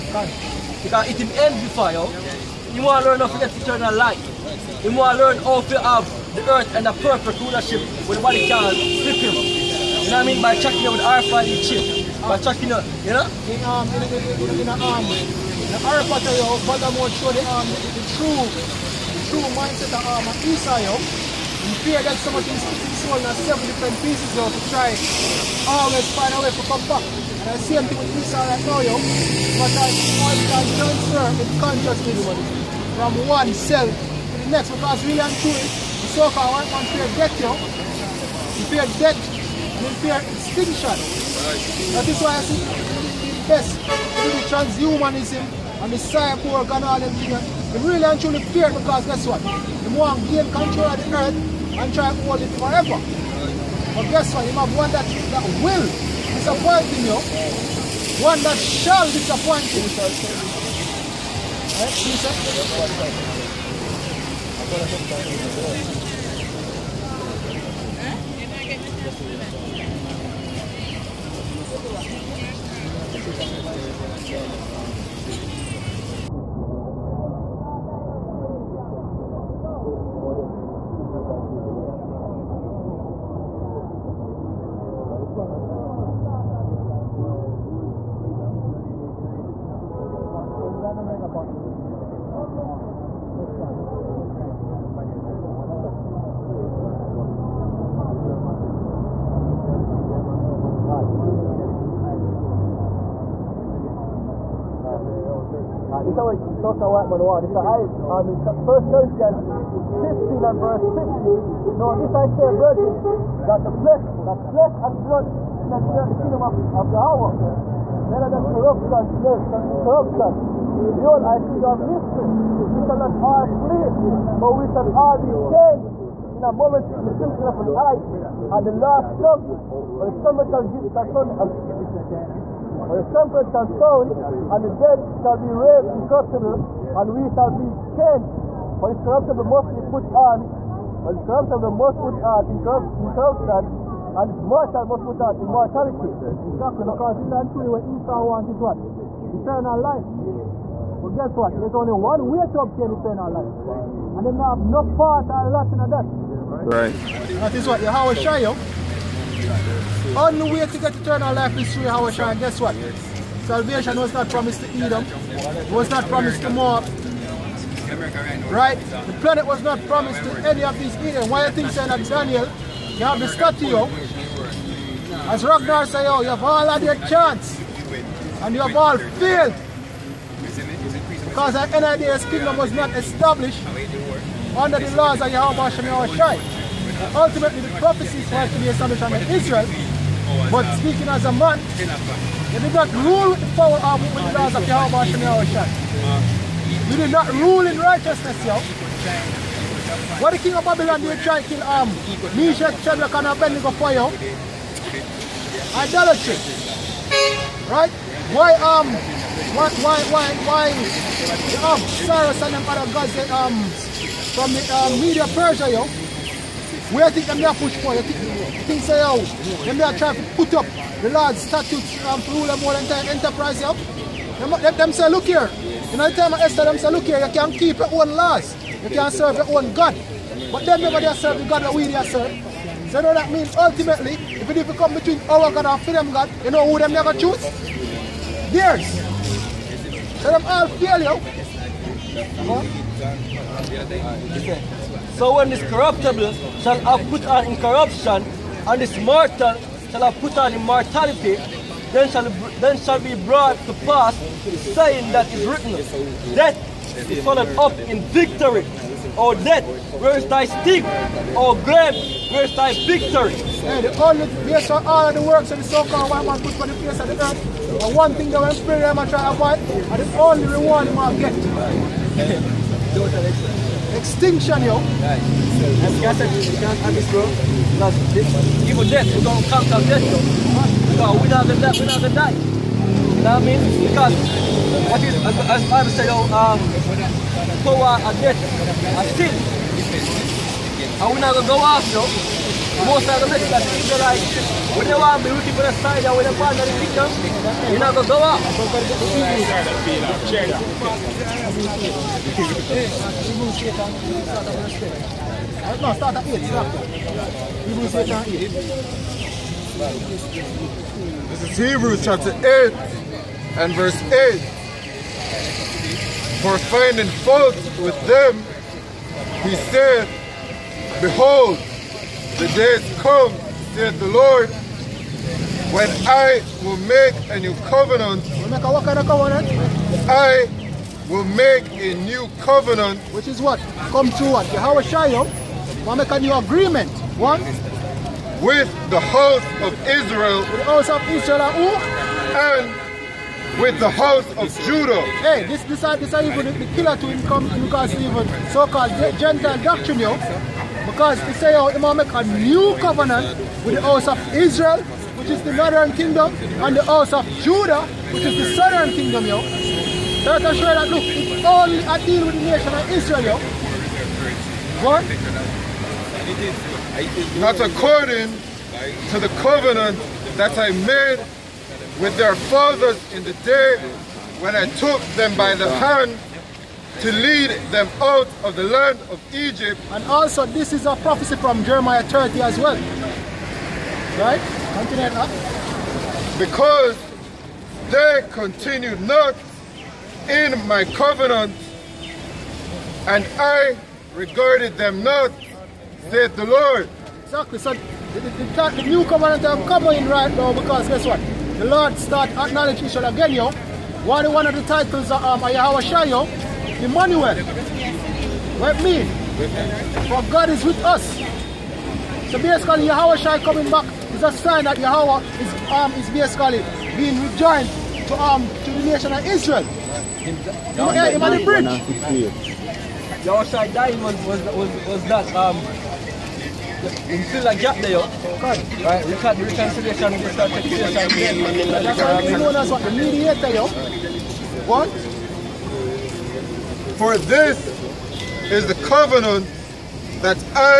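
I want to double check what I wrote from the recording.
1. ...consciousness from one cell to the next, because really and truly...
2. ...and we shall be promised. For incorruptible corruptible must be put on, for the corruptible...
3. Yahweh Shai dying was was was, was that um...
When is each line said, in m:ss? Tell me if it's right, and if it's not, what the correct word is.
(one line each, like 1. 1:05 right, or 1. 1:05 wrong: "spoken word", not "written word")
1. 0:31 right
2. 2:16 wrong: "changed", not "promised"
3. 7:03 right.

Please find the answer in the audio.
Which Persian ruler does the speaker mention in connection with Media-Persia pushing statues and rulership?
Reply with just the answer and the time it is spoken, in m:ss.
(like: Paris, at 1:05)
Cyrus, at 3:32.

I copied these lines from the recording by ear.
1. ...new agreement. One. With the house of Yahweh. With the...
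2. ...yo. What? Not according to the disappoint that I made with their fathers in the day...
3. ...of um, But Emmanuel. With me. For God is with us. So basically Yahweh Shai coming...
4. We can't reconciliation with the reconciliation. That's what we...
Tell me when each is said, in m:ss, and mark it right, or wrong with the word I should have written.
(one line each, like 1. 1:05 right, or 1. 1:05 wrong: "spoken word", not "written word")
1. 5:36 wrong: "Israel", not "Yahweh"
2. 6:03 wrong: "covenant", not "disappoint"
3. 6:45 wrong: "Yahweh", not "But"
4. 7:09 right.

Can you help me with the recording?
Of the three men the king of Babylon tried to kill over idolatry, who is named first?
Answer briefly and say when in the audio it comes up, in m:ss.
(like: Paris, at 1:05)
Meshach, at 3:22.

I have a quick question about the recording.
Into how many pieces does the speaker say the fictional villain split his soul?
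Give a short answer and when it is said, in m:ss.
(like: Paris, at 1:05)
7, at 0:23.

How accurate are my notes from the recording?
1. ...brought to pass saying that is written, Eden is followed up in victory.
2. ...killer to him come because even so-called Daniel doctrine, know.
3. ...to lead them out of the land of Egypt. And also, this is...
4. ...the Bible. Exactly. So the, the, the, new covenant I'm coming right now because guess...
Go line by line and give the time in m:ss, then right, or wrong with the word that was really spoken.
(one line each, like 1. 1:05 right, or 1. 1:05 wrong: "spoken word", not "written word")
1. 4:13 wrong: "Death", not "Eden"
2. 5:46 wrong: "Gentile", not "Daniel"
3. 6:17 right
4. 6:36 wrong: "Lord", not "Bible".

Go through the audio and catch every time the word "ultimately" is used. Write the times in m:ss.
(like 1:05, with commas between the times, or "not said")
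3:07, 3:53.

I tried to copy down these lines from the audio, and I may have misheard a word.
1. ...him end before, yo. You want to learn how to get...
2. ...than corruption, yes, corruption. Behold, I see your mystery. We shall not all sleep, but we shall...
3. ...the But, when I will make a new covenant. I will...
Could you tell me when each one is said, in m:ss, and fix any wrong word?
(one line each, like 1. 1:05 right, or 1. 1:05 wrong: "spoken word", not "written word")
1. 0:01 right
2. 1:58 right
3. 5:23 wrong: "Lord", not "But".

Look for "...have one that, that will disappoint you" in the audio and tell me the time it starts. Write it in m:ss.
0:54.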